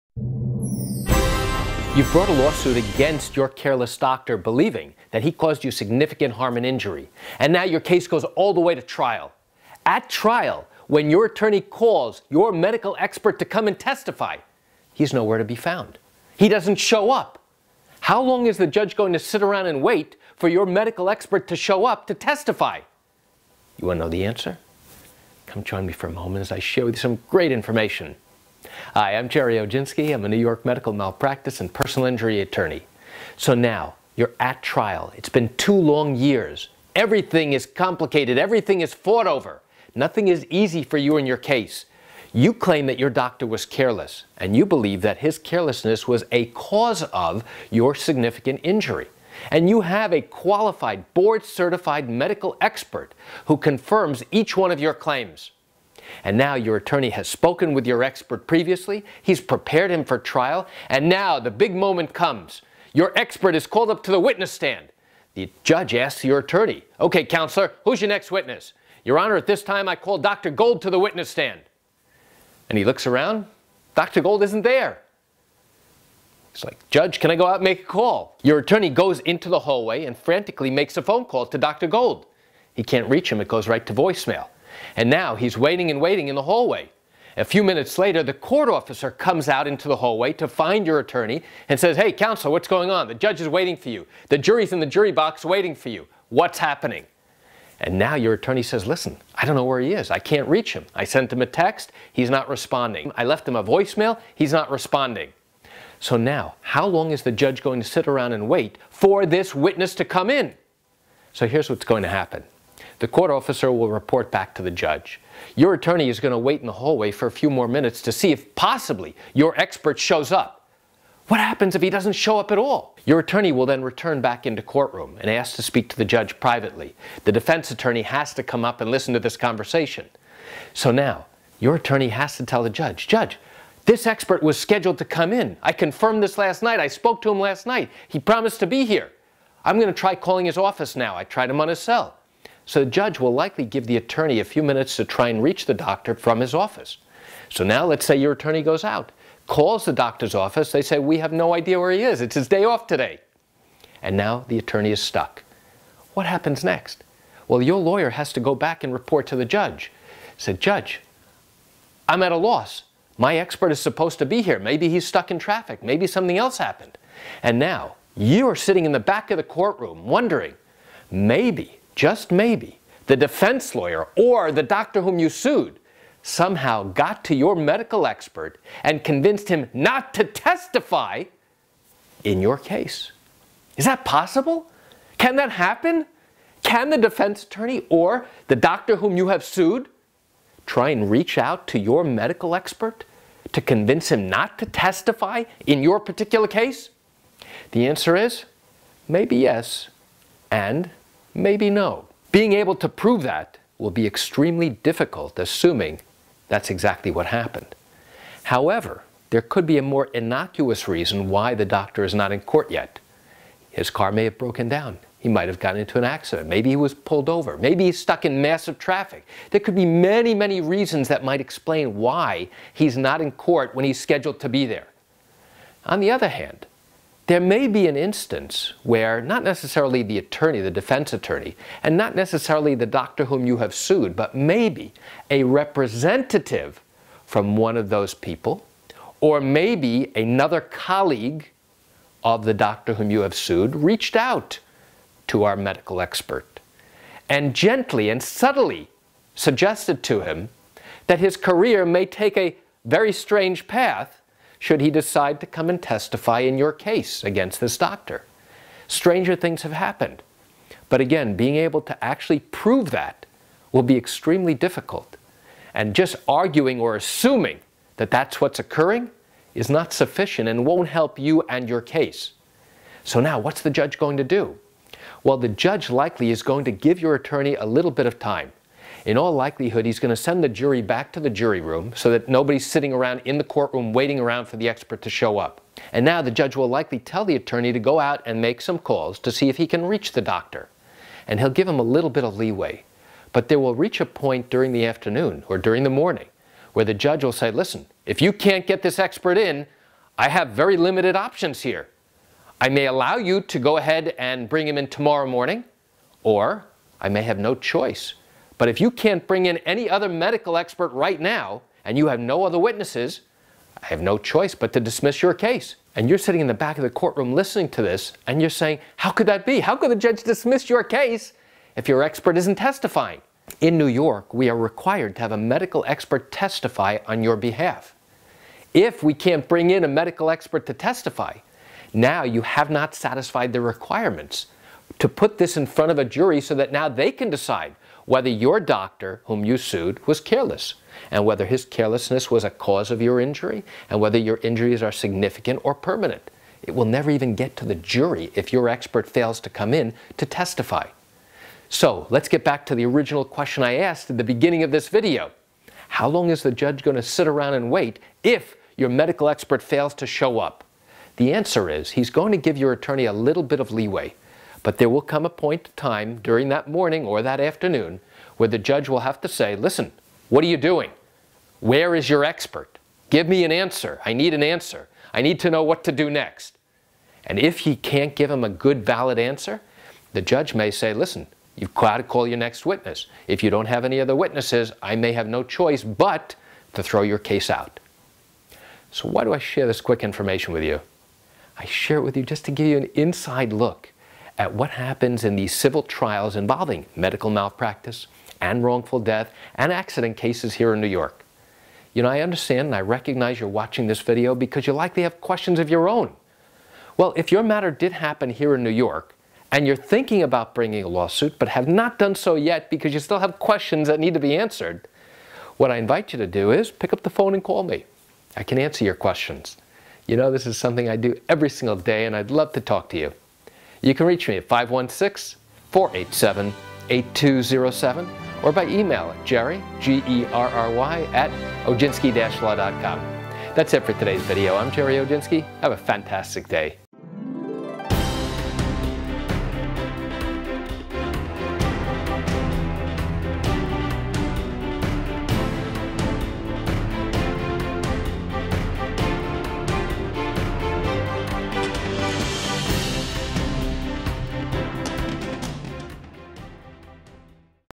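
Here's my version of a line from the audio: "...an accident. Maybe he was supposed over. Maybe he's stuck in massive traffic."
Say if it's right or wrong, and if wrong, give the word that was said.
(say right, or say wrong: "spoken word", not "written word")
wrong: "pulled", not "supposed".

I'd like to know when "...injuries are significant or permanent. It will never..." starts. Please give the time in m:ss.
5:44.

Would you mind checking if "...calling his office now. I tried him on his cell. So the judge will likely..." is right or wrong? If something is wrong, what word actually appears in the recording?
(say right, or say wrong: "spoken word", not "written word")
right.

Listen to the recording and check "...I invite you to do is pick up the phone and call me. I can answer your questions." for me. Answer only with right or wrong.
right.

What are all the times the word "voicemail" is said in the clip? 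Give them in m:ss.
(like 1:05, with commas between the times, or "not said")
1:23, 1:43.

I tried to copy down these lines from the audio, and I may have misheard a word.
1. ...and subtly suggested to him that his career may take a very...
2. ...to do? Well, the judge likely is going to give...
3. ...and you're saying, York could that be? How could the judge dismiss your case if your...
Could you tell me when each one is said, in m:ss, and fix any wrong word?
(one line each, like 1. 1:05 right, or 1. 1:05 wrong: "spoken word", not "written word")
1. 4:08 right
2. 4:34 right
3. 5:18 wrong: "How", not "York".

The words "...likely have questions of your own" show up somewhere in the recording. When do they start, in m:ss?
6:44.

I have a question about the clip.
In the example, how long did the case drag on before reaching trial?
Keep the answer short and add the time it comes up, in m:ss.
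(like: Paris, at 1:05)
2 years, at 0:35.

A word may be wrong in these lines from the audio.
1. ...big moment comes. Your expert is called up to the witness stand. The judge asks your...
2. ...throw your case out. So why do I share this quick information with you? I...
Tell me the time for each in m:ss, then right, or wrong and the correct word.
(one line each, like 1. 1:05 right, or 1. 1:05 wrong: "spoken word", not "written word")
1. 1:01 right
2. 6:26 right.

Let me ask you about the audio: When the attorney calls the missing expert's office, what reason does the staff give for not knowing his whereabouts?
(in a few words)
His day off.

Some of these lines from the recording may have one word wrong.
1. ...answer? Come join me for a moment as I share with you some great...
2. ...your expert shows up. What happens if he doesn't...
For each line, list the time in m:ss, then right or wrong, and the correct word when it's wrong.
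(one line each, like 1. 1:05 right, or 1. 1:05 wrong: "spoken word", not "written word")
1. 0:24 right
2. 1:59 right.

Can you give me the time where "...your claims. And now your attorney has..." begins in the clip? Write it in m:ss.
0:54.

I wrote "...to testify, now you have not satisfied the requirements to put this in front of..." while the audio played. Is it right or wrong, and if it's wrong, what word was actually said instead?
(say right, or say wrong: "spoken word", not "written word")
right.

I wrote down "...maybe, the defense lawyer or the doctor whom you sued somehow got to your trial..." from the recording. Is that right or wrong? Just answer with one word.
wrong.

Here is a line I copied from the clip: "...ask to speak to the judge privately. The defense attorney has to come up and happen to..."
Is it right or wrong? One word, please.
wrong.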